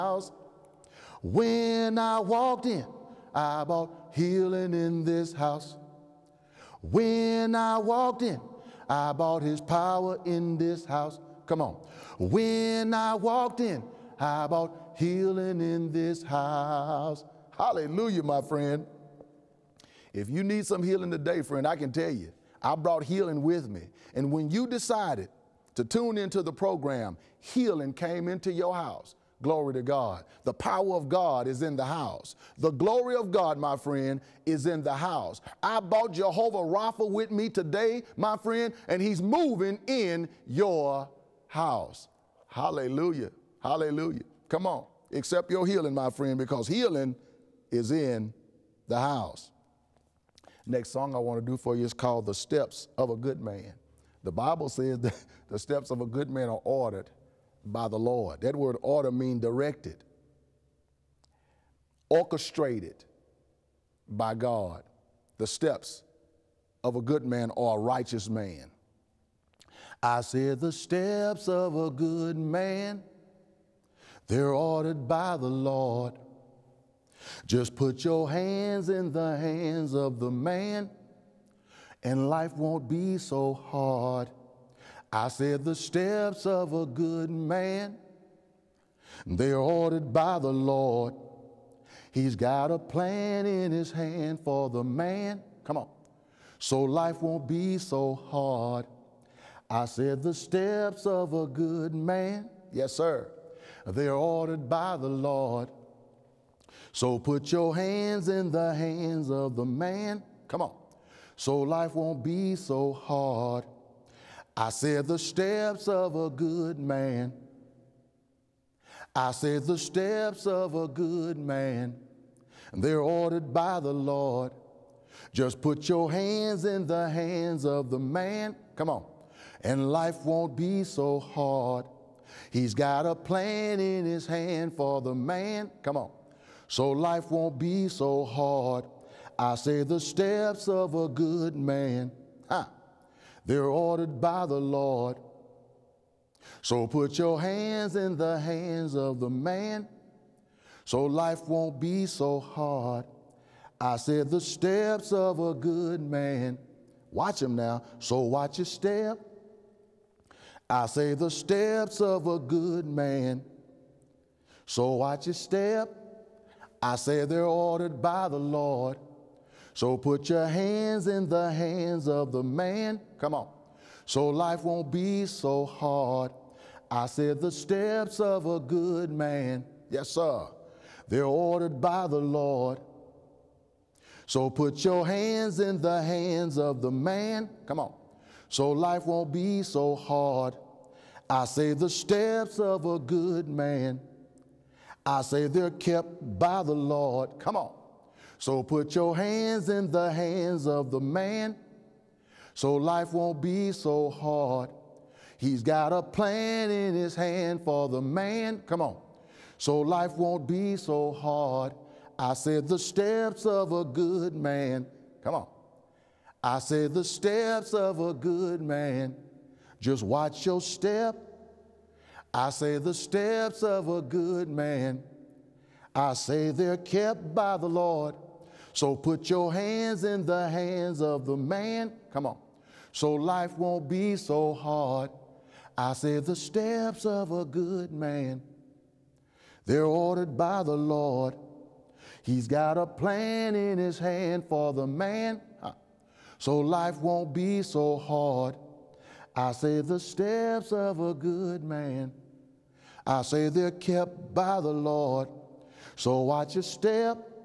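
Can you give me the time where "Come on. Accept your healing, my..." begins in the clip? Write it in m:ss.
0:44.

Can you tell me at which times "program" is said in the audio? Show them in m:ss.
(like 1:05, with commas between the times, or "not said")
0:26.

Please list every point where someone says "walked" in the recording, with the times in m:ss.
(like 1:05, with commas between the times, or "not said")
0:02, 0:07, 0:13.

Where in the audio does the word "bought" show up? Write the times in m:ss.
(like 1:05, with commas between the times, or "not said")
0:03, 0:09, 0:35.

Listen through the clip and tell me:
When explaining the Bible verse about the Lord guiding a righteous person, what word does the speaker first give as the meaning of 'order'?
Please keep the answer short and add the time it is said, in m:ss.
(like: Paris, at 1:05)
directed, at 0:59.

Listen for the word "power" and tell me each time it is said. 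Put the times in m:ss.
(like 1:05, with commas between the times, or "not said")
0:09, 0:30.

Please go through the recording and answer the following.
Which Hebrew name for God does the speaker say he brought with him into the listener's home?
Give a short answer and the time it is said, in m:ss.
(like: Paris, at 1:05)
Jehovah Rapha, at 0:36.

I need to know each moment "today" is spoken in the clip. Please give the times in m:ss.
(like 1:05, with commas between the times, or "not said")
0:21, 0:37.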